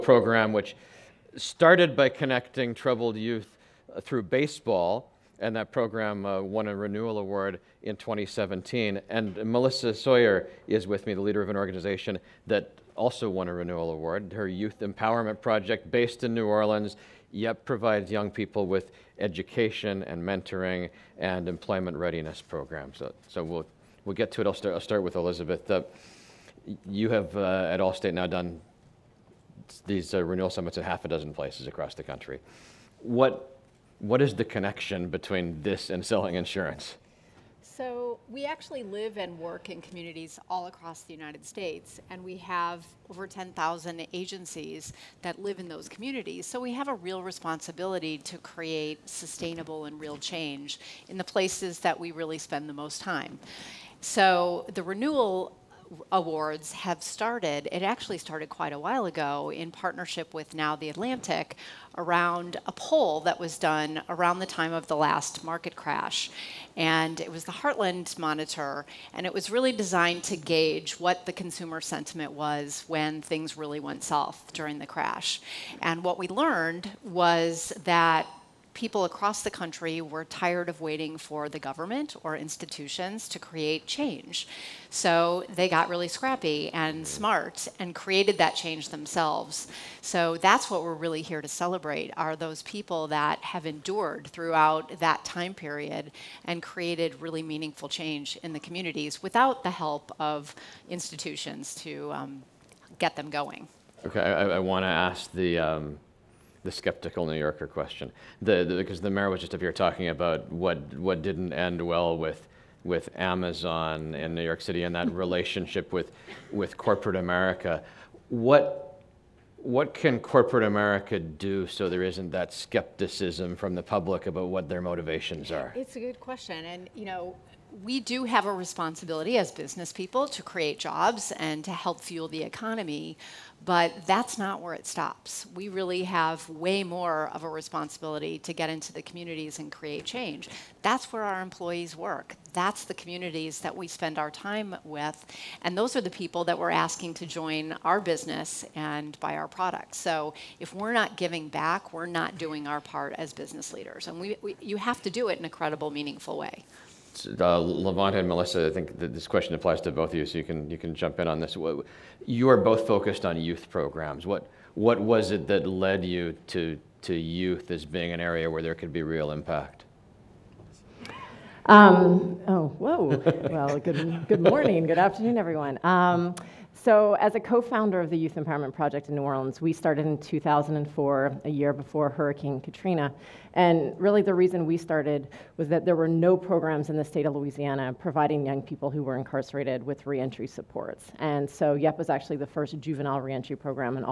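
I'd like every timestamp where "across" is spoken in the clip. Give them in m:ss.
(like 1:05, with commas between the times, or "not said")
0:31, 0:40, 1:19.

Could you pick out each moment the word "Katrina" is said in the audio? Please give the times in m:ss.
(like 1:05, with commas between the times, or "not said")
3:02.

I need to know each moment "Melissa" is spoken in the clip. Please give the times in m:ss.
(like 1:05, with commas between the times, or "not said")
0:09, 2:38.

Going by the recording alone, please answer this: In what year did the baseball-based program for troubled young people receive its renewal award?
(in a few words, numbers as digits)
2017.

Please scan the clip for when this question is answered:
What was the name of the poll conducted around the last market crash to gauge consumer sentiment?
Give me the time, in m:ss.
1:07.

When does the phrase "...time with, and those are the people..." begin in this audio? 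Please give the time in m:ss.
2:24.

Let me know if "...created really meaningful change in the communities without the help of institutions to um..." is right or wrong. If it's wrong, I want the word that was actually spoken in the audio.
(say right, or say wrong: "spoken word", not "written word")
right.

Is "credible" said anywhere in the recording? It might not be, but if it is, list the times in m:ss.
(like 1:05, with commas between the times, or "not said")
2:35.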